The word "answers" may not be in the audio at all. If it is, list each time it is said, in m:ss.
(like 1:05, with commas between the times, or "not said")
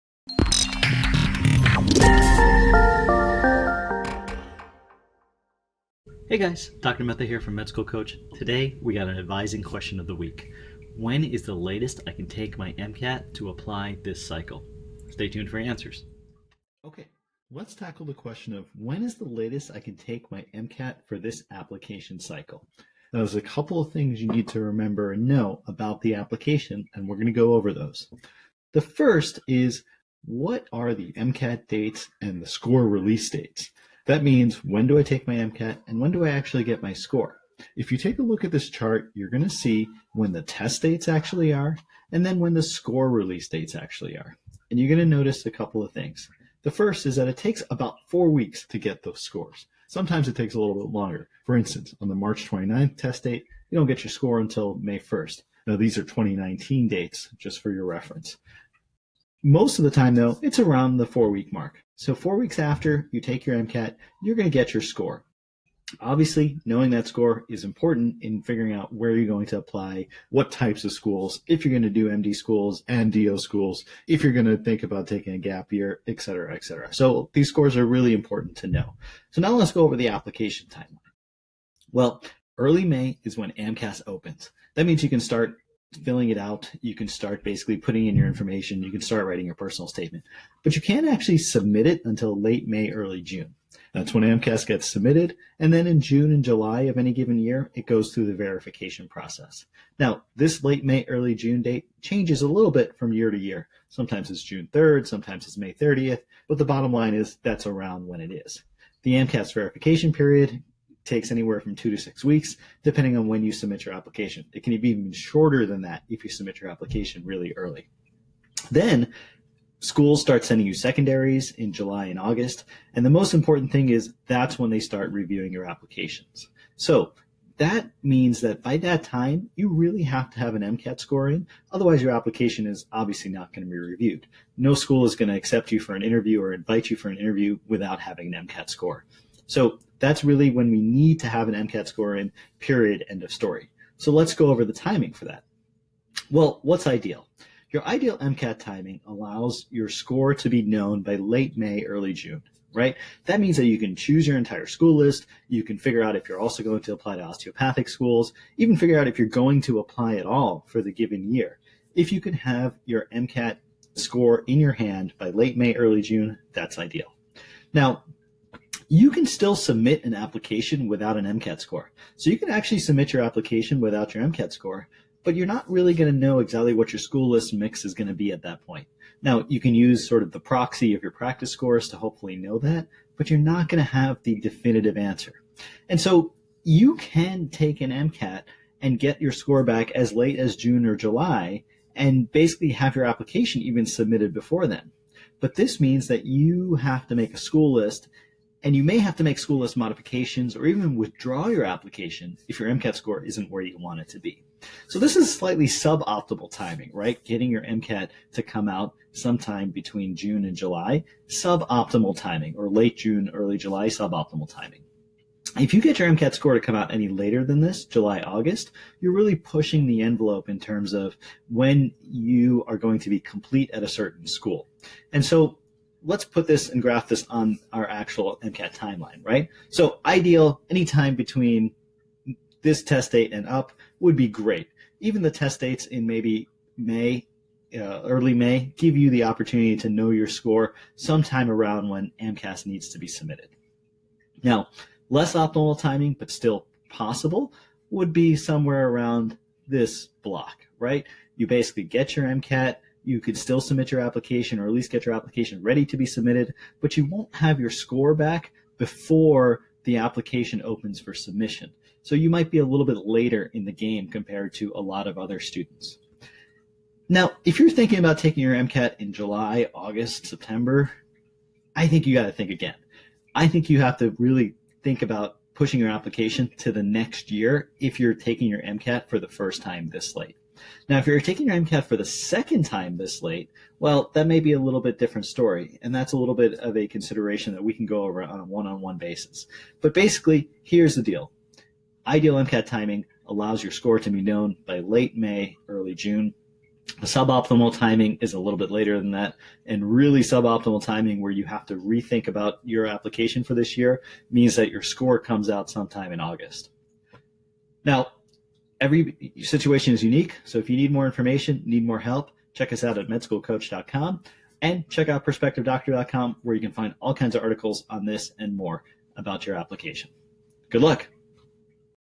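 0:15, 3:04.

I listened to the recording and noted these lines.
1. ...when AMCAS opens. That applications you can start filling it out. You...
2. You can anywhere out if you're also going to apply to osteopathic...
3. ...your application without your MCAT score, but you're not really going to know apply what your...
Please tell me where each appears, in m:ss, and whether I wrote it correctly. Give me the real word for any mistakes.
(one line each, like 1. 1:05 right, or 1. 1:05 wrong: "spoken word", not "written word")
1. 1:23 wrong: "means", not "applications"
2. 2:35 wrong: "figure", not "anywhere"
3. 2:53 wrong: "exactly", not "apply".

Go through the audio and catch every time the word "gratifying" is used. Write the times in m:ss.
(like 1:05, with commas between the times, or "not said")
not said.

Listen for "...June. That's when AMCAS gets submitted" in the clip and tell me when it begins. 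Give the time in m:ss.
1:33.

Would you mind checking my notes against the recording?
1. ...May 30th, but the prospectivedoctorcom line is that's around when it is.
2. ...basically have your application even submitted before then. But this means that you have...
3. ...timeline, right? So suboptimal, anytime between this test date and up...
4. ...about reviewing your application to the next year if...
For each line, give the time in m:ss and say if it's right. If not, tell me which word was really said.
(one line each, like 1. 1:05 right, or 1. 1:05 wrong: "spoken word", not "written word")
1. 1:45 wrong: "bottom", not "prospectivedoctorcom"
2. 3:12 right
3. 3:48 wrong: "ideal", not "suboptimal"
4. 4:35 wrong: "pushing", not "reviewing".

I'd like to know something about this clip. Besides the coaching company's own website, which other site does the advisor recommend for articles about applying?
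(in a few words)
prospectivedoctor.com.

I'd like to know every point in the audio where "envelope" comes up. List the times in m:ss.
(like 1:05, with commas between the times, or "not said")
3:40.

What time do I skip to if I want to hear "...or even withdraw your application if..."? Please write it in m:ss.
3:20.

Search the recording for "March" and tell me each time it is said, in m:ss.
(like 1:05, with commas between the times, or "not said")
0:52.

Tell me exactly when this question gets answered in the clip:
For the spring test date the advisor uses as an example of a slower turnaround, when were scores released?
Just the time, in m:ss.
0:54.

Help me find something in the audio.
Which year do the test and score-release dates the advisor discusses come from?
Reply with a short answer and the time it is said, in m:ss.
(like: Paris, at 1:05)
2019, at 0:56.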